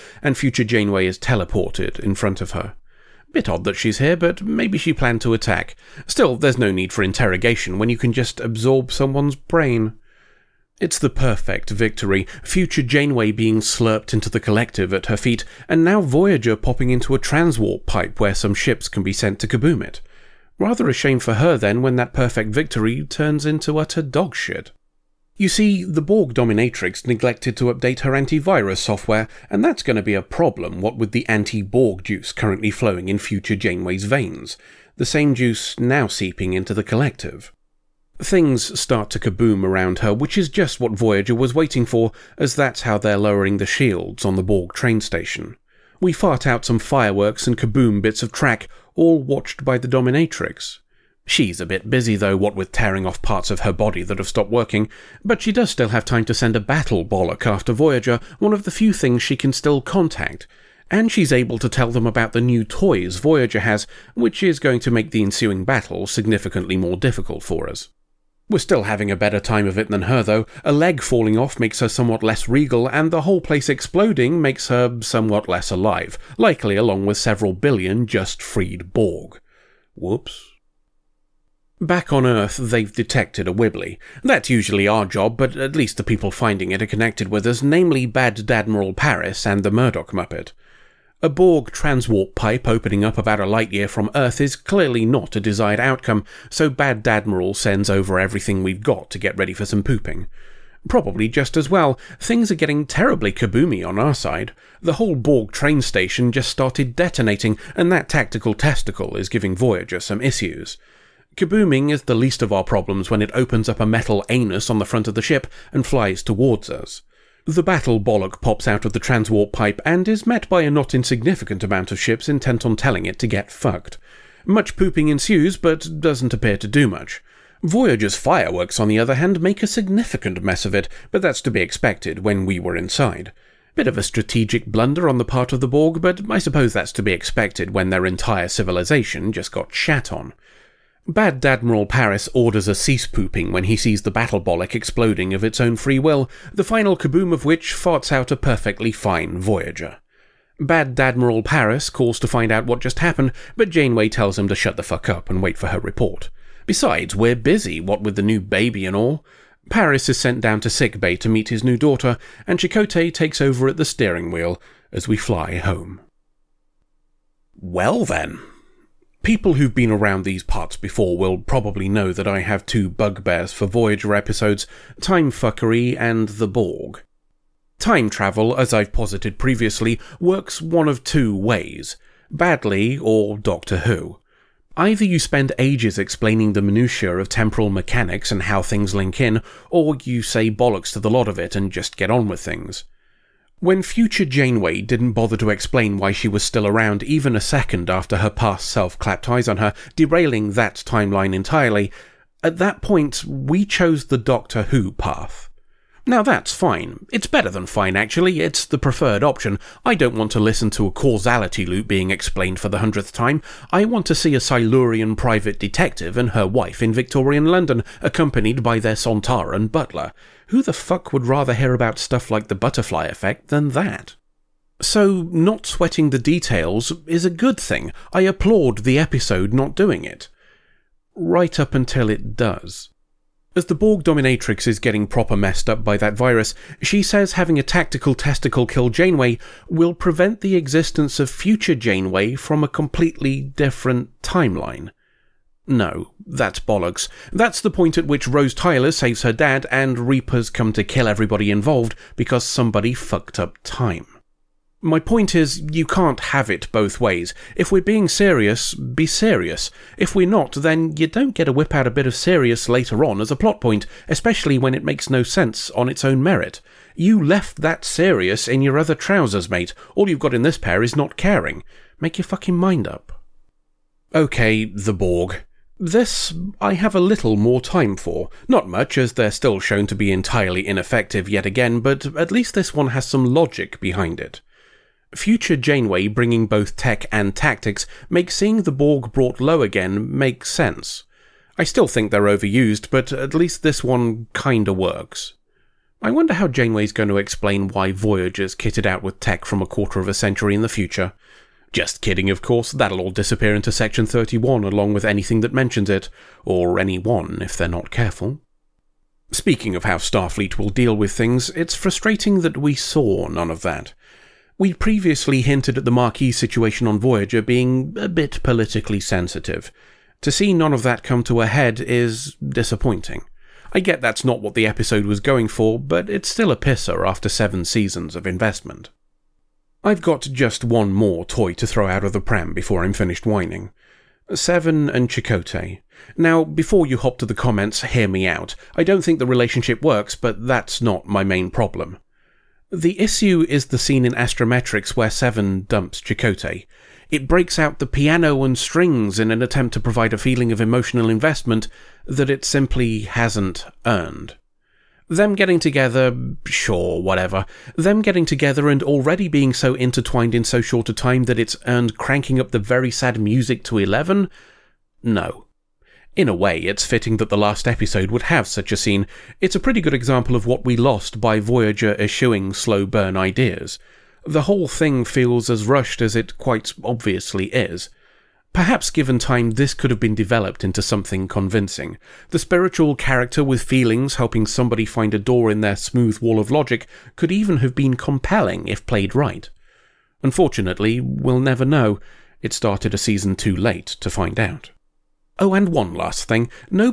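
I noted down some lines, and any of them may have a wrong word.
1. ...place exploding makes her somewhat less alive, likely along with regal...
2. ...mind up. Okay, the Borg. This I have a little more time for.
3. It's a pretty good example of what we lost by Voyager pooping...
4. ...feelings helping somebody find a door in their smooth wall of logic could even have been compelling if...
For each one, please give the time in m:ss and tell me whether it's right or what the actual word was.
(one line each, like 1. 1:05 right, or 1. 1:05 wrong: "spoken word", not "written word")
1. 1:13 wrong: "several", not "regal"
2. 4:32 right
3. 6:09 wrong: "eschewing", not "pooping"
4. 6:23 right.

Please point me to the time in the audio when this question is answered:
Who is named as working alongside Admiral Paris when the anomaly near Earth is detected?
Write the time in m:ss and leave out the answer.
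1:29.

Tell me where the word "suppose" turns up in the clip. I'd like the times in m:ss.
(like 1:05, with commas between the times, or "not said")
2:16.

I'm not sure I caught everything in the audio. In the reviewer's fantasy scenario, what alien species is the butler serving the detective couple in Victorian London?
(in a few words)
Sontaran.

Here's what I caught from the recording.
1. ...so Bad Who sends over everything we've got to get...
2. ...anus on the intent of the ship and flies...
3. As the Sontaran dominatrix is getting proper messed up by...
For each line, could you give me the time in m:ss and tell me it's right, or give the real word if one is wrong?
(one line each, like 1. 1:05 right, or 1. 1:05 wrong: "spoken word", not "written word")
1. 1:36 wrong: "Admiral", not "Who"
2. 1:54 wrong: "front", not "intent"
3. 3:53 wrong: "Borg", not "Sontaran".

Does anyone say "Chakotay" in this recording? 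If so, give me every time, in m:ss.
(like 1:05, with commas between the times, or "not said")
2:42, 5:35, 5:46.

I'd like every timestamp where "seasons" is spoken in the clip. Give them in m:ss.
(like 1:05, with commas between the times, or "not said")
5:27, 6:32.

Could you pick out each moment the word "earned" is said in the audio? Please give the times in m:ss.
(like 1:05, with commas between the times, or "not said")
5:53, 6:01.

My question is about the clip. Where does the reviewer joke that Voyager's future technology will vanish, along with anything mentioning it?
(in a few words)
Section 31.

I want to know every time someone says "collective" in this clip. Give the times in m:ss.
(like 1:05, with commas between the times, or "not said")
0:14, 0:36.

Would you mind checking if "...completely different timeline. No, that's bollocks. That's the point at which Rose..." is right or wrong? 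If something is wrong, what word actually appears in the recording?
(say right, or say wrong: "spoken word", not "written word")
right.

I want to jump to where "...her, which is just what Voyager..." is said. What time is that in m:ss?
0:40.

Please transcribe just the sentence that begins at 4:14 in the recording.
My point is, you can't have it both ways.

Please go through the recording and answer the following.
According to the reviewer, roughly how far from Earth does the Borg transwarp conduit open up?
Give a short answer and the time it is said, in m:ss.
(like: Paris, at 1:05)
a light year, at 1:33.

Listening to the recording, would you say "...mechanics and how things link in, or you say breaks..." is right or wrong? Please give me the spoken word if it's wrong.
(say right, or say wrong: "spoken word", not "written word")
wrong: "bollocks", not "breaks".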